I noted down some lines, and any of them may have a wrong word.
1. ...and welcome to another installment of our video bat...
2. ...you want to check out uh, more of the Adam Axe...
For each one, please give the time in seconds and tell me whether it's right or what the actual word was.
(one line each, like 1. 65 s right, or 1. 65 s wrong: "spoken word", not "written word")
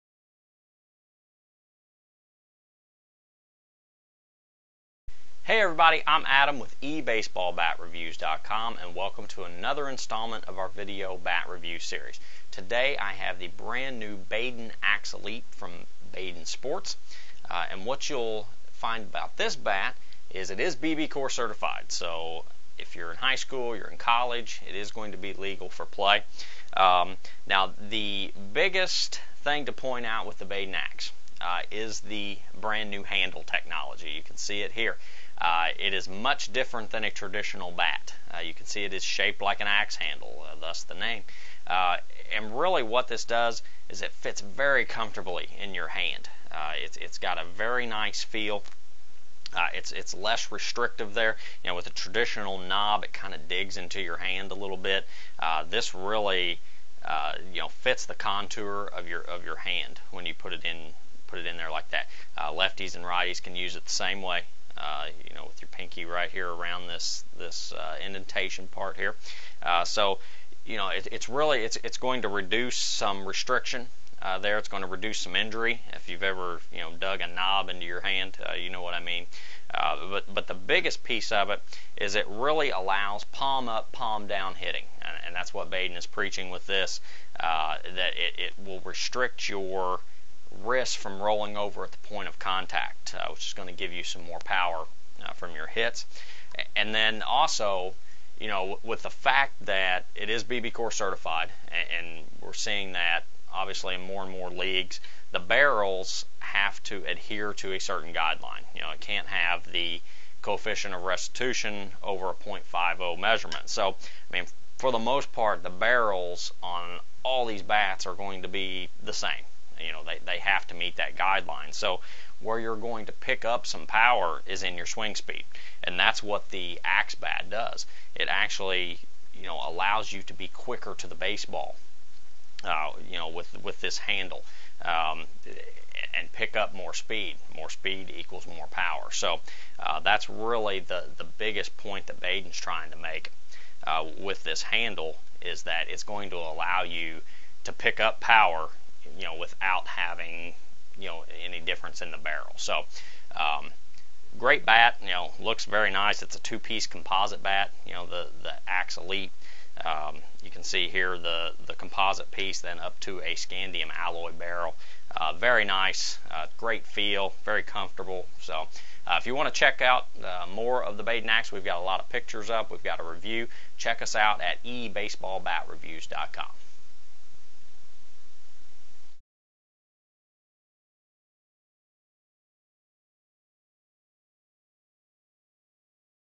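1. 8 s right
2. 169 s wrong: "Baden", not "Adam".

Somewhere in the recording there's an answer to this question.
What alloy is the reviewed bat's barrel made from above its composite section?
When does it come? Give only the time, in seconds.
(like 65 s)
163 s.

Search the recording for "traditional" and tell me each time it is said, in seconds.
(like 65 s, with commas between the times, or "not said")
37 s, 51 s.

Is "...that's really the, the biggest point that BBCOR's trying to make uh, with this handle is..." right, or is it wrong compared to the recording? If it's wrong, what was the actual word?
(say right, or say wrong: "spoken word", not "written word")
wrong: "Baden", not "BBCOR".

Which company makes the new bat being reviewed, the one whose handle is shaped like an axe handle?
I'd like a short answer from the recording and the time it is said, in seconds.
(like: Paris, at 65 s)
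Baden Sports, at 16 s.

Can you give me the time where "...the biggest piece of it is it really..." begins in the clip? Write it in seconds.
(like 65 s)
80 s.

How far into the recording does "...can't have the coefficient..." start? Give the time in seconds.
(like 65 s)
108 s.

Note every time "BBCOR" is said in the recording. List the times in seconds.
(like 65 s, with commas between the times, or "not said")
20 s, 100 s.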